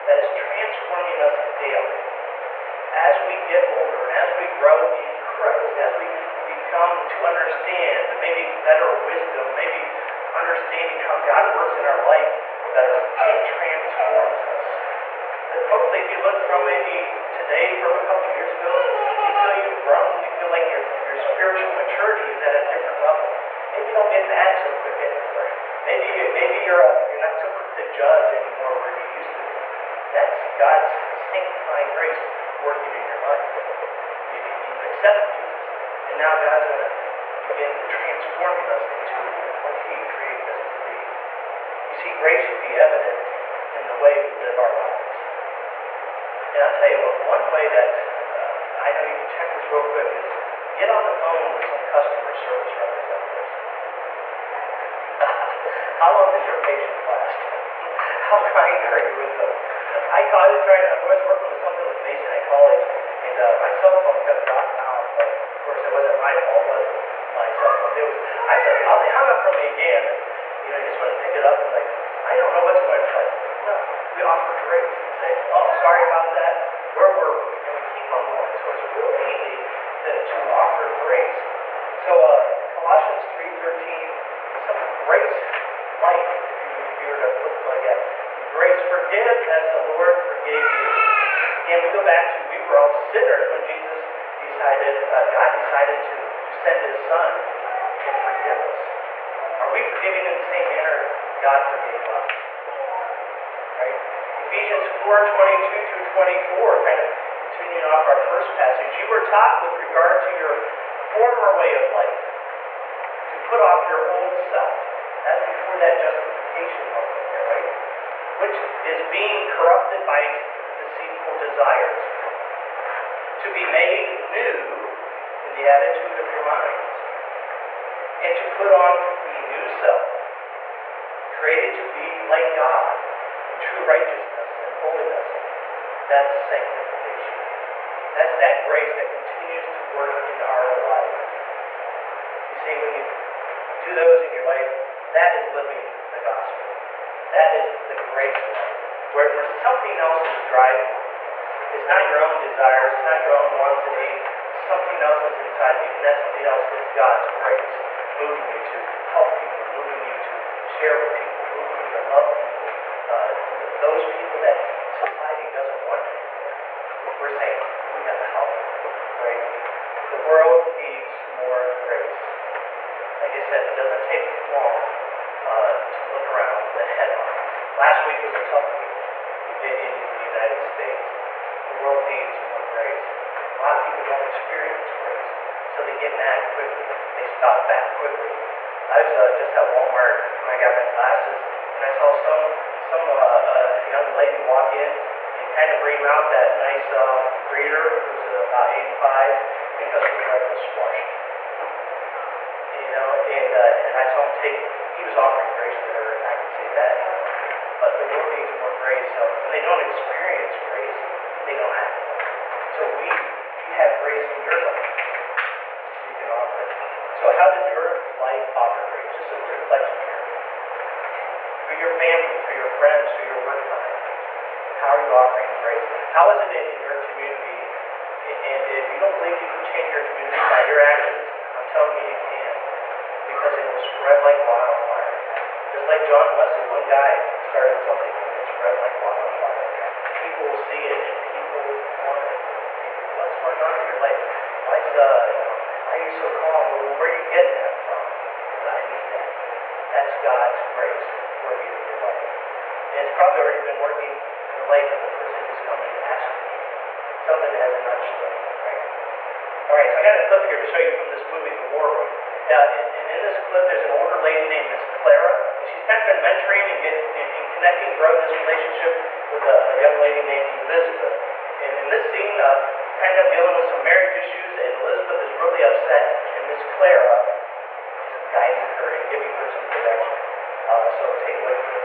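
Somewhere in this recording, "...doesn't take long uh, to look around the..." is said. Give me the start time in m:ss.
2:53.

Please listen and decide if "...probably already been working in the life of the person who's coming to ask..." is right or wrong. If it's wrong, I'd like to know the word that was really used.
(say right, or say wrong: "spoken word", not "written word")
right.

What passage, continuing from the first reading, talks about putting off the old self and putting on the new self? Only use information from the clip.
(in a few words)
Ephesians 4:22-24.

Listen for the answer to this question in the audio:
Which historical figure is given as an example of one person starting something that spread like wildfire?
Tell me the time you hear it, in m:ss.
3:56.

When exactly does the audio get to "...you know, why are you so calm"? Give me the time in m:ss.
4:05.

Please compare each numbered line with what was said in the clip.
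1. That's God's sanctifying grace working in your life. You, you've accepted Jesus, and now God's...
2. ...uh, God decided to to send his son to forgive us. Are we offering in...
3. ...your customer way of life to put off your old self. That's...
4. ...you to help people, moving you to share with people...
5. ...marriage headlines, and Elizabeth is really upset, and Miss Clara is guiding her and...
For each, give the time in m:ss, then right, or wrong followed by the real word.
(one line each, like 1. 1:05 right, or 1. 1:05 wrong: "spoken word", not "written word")
1. 0:30 right
2. 1:35 wrong: "forgiving", not "offering"
3. 1:50 wrong: "former", not "customer"
4. 2:38 right
5. 4:33 wrong: "issues", not "headlines".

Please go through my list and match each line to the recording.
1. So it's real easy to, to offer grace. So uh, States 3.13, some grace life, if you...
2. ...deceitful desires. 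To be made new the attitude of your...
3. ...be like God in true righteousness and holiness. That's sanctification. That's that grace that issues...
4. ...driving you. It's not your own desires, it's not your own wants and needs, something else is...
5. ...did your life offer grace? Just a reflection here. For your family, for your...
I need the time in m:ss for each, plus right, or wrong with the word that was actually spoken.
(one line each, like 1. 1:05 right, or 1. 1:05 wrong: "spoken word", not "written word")
1. 1:18 wrong: "Colossians", not "States"
2. 2:00 right
3. 2:11 wrong: "continues", not "issues"
4. 2:30 right
5. 3:37 right.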